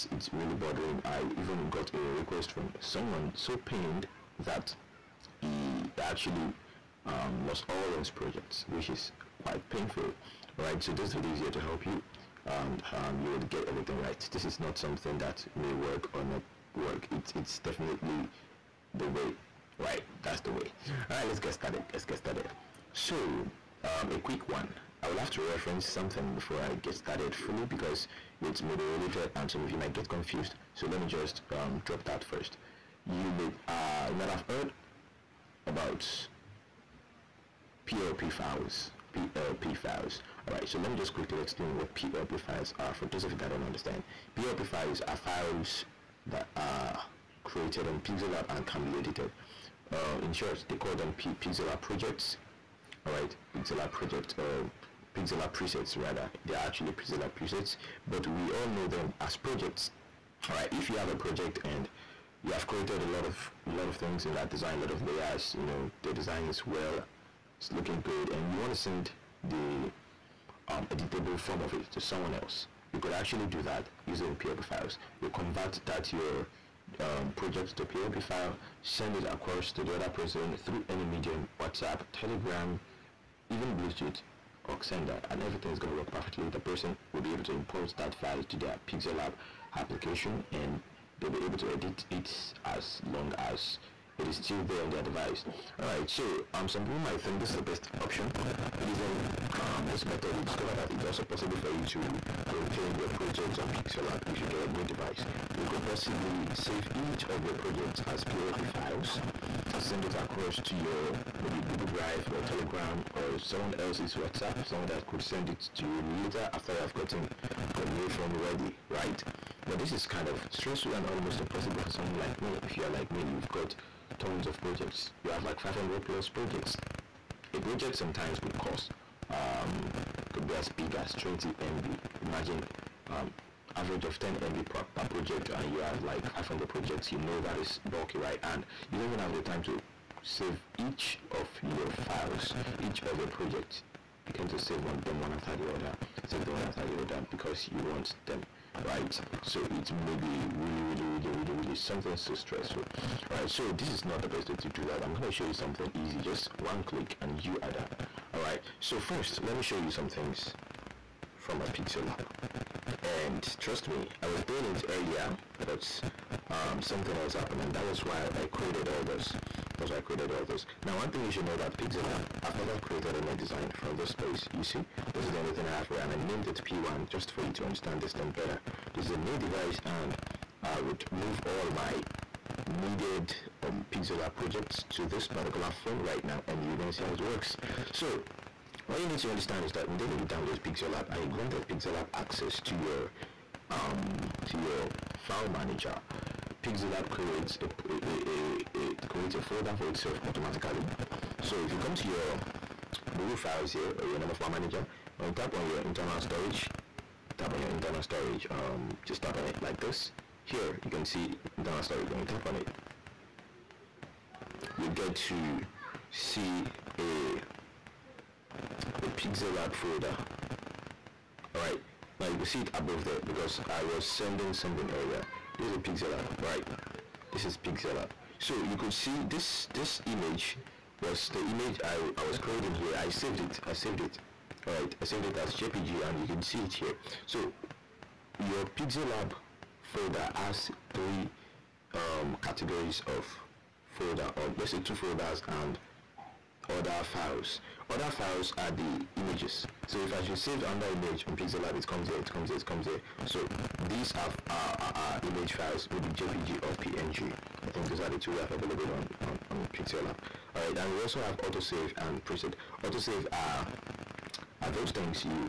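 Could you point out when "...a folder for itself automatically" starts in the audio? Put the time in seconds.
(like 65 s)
199 s.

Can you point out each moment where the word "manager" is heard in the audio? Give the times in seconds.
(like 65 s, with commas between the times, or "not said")
195 s, 204 s.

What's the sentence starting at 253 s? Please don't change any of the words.
So these are our, our, image files, maybe JPG or PNG.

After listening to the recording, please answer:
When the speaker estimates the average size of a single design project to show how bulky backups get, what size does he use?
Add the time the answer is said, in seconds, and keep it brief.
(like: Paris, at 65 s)
10 MB, at 134 s.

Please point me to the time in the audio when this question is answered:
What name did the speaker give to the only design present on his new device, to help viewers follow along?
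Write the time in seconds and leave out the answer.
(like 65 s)
176 s.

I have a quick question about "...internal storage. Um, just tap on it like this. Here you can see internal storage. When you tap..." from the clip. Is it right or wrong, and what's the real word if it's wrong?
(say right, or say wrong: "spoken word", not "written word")
right.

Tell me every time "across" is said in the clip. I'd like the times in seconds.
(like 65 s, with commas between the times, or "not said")
79 s, 110 s.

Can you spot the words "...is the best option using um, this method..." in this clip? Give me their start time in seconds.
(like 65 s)
97 s.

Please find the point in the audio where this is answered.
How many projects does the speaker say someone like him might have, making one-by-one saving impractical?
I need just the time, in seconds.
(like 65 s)
125 s.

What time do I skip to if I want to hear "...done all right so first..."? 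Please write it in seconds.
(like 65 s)
157 s.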